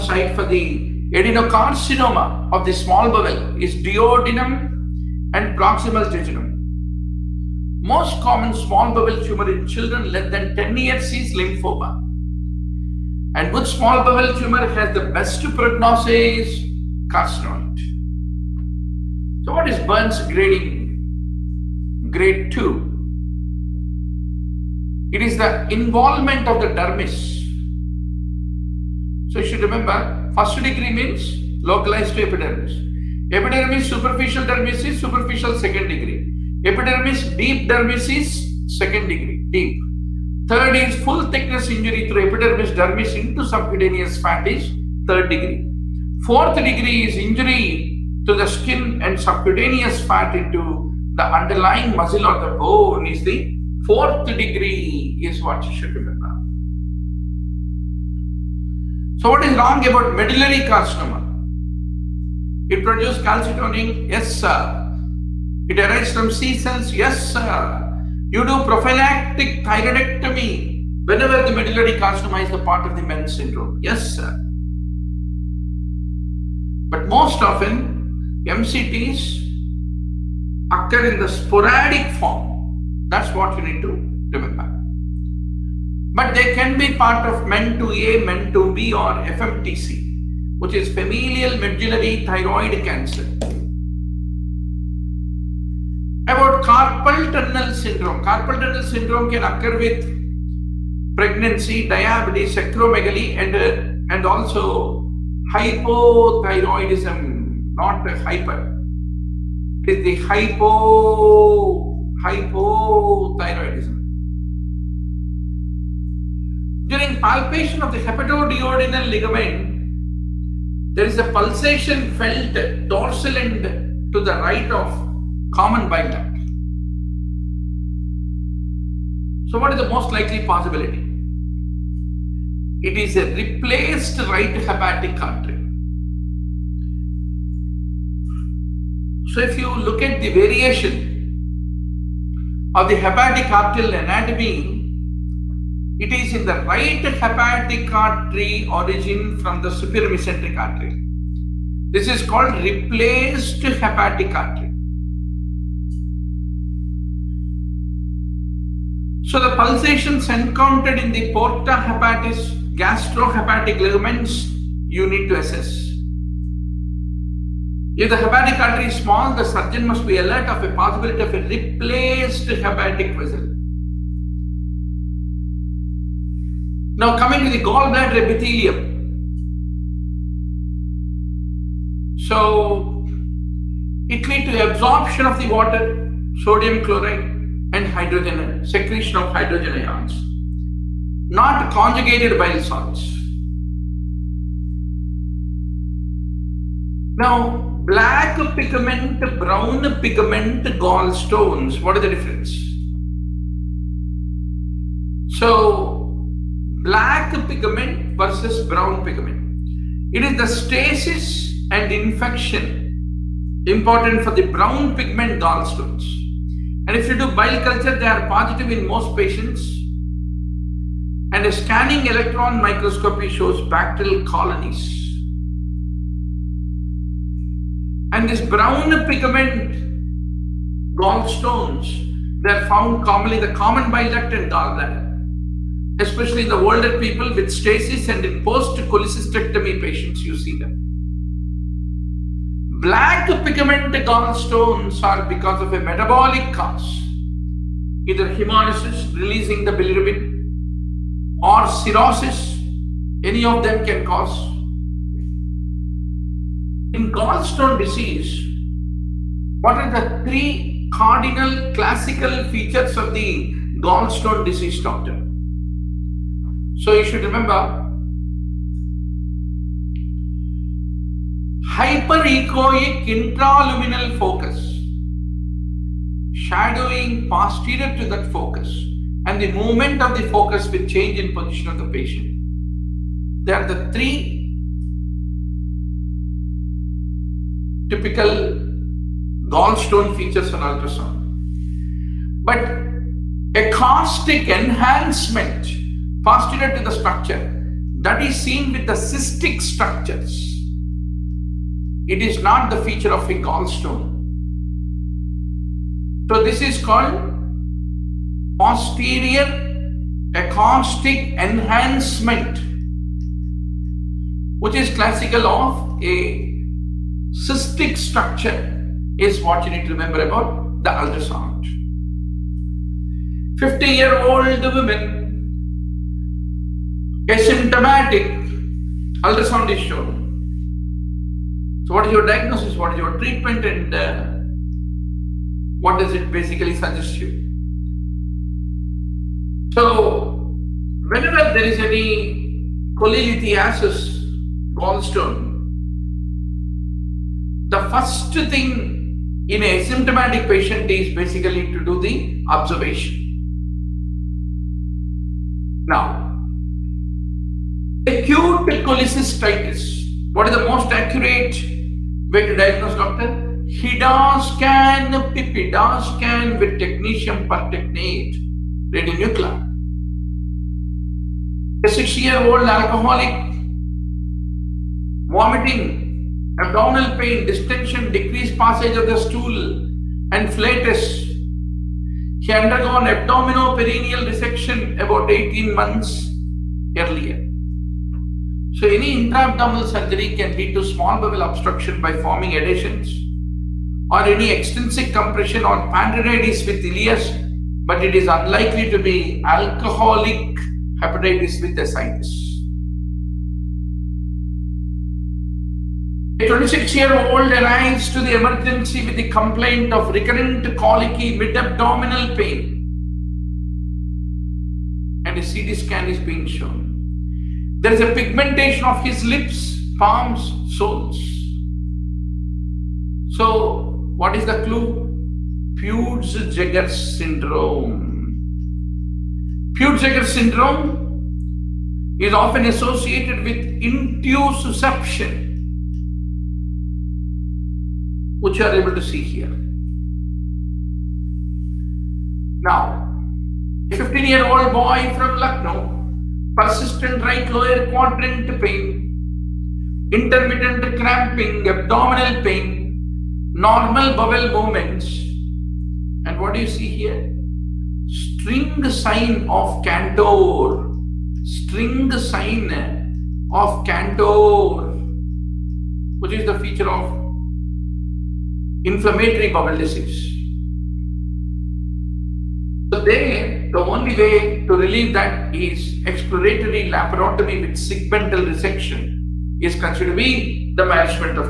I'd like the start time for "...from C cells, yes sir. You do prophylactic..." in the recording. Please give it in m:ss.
1:06.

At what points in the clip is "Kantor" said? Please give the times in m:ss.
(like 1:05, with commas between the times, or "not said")
7:39, 7:43.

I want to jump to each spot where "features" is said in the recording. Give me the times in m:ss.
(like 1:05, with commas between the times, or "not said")
4:22, 4:50, 5:02, 7:46.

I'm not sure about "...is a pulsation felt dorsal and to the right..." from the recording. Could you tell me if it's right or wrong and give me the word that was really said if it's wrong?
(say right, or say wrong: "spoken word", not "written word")
right.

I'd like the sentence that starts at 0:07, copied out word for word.
Most common small bowel tumor in children less than 10 years is lymphoma.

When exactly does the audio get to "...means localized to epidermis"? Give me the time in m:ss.
0:30.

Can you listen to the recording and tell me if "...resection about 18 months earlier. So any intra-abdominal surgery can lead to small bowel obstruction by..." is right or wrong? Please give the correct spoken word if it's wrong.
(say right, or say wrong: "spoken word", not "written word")
right.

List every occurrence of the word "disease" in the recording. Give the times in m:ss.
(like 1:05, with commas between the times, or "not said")
4:17, 4:24, 7:49.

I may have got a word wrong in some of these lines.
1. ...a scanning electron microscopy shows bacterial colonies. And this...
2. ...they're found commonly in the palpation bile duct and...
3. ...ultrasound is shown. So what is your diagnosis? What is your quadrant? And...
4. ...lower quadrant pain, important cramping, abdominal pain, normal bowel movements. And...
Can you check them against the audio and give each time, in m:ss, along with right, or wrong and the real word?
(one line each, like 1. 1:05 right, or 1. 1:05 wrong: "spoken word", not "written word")
1. 3:41 right
2. 3:52 wrong: "common", not "palpation"
3. 5:29 wrong: "treatment", not "quadrant"
4. 7:27 wrong: "intermittent", not "important".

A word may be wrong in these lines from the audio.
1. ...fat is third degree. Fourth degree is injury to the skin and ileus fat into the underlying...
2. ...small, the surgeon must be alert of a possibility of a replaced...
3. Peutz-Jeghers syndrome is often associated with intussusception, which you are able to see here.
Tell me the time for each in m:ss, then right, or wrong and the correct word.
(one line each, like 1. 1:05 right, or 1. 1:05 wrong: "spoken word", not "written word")
1. 0:44 wrong: "subcutaneous", not "ileus"
2. 2:48 right
3. 7:09 right.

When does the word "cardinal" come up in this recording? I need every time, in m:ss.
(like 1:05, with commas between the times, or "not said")
4:20.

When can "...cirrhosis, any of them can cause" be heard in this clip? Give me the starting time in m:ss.
4:11.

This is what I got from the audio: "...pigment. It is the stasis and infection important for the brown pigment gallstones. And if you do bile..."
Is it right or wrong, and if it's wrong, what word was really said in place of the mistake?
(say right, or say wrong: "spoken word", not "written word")
right.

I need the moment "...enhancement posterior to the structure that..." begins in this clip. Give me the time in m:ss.
4:54.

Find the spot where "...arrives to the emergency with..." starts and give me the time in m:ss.
6:47.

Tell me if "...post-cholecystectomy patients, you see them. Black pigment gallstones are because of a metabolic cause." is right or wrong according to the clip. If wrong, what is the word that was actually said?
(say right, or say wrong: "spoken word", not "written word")
right.